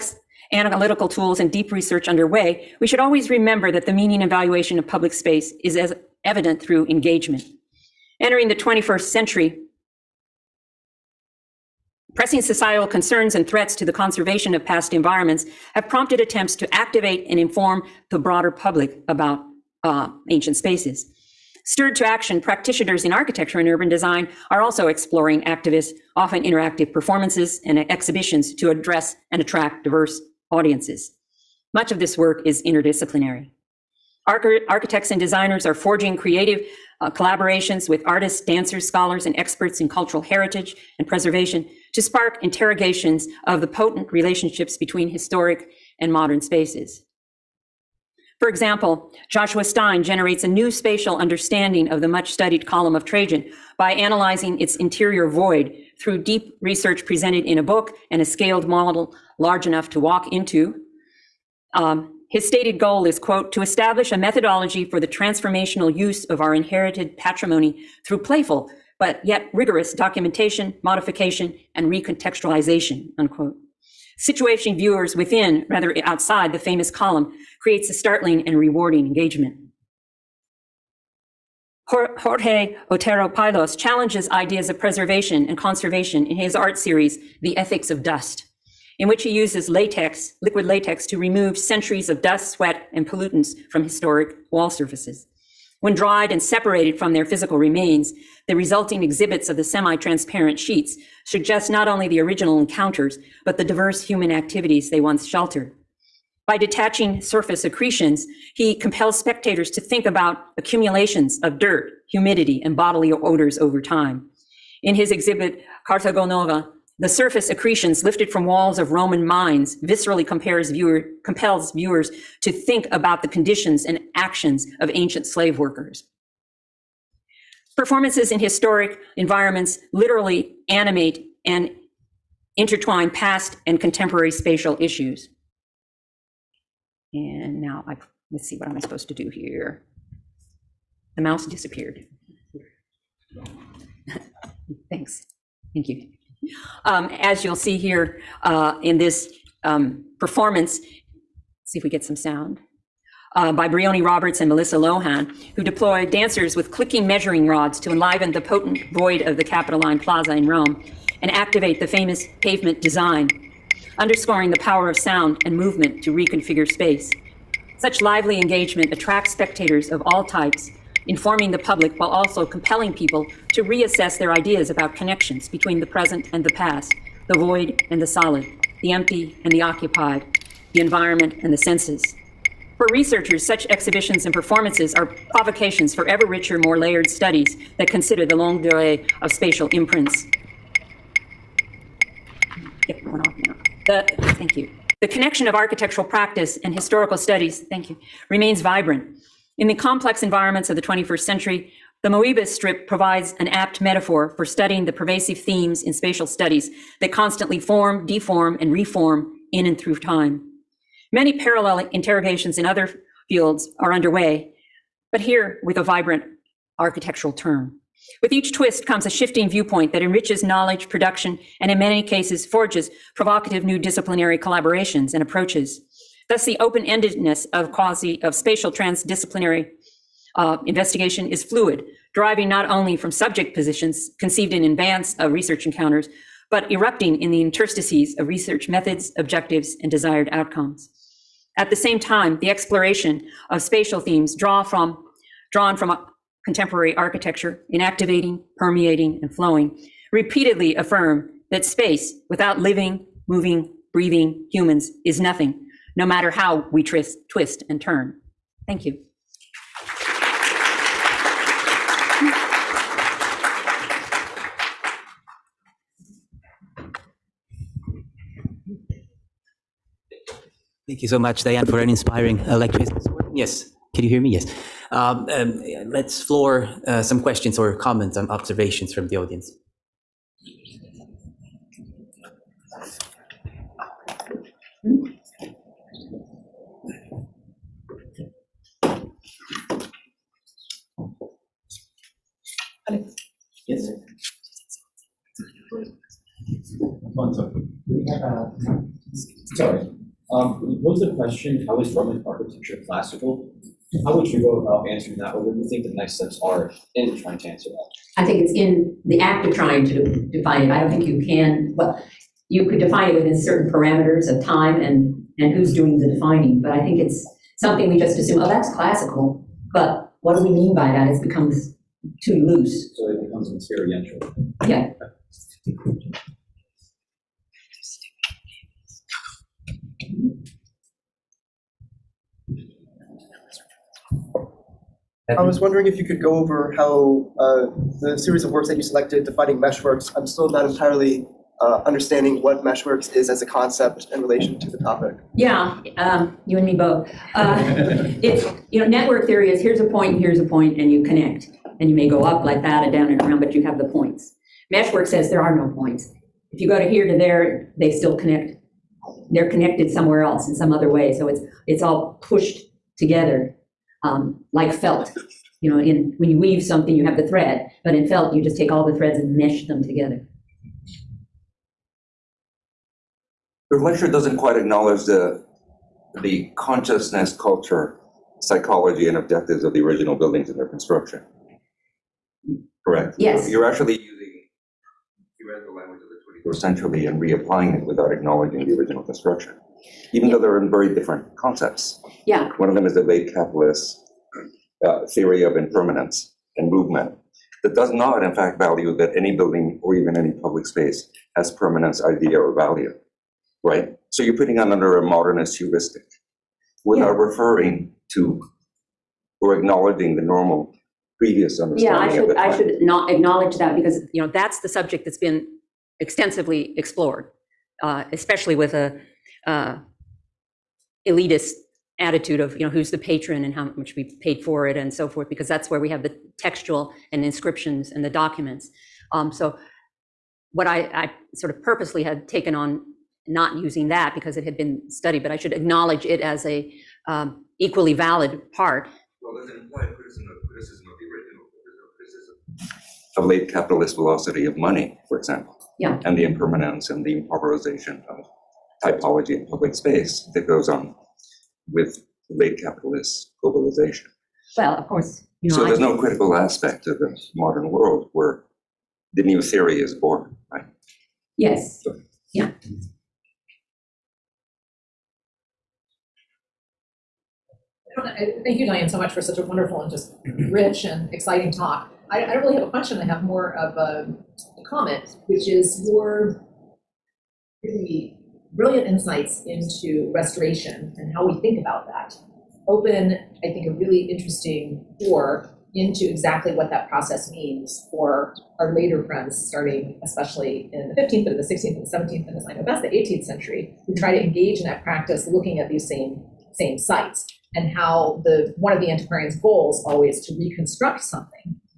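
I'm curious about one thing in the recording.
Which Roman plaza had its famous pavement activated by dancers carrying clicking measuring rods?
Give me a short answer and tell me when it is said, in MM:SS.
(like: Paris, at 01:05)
Capitoline Plaza, at 02:39.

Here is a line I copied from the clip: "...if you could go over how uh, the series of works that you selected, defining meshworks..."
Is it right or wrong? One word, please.
right.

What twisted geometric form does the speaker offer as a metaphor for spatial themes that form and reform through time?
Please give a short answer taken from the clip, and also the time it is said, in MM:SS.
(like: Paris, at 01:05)
Moebius strip, at 03:22.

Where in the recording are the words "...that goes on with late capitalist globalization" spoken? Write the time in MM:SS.
07:30.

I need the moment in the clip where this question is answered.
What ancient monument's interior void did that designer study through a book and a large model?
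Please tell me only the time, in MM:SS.
00:52.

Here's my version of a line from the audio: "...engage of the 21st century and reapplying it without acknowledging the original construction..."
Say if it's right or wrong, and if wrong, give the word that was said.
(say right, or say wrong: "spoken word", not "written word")
wrong: "language", not "engage".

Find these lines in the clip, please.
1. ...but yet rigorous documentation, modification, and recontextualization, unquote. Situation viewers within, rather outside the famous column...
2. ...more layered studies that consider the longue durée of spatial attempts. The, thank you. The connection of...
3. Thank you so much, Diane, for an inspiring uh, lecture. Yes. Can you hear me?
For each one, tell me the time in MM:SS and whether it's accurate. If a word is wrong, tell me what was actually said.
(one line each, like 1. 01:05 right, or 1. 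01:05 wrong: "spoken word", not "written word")
1. 01:08 right
2. 03:06 wrong: "imprints", not "attempts"
3. 04:30 right.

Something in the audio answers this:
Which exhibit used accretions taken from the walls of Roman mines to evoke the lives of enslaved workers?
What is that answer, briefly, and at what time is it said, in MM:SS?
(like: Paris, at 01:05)
Cartago Nova, at 01:55.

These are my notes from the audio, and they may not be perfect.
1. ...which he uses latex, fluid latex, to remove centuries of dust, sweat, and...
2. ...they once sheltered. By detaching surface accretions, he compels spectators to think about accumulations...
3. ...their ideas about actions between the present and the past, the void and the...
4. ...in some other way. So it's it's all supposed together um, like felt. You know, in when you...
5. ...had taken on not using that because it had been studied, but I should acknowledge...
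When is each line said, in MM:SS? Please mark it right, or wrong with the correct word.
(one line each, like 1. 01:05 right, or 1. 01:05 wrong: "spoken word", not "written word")
1. 01:29 wrong: "liquid", not "fluid"
2. 01:44 right
3. 02:54 wrong: "connections", not "actions"
4. 06:00 wrong: "pushed", not "supposed"
5. 07:12 right.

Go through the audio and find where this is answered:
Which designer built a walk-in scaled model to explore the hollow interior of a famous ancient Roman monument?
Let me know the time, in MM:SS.
00:49.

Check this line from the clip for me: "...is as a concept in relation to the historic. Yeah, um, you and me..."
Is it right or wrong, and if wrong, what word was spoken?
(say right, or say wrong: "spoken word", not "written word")
wrong: "topic", not "historic".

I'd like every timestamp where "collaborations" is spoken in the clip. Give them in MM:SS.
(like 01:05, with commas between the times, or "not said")
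00:37, 03:44.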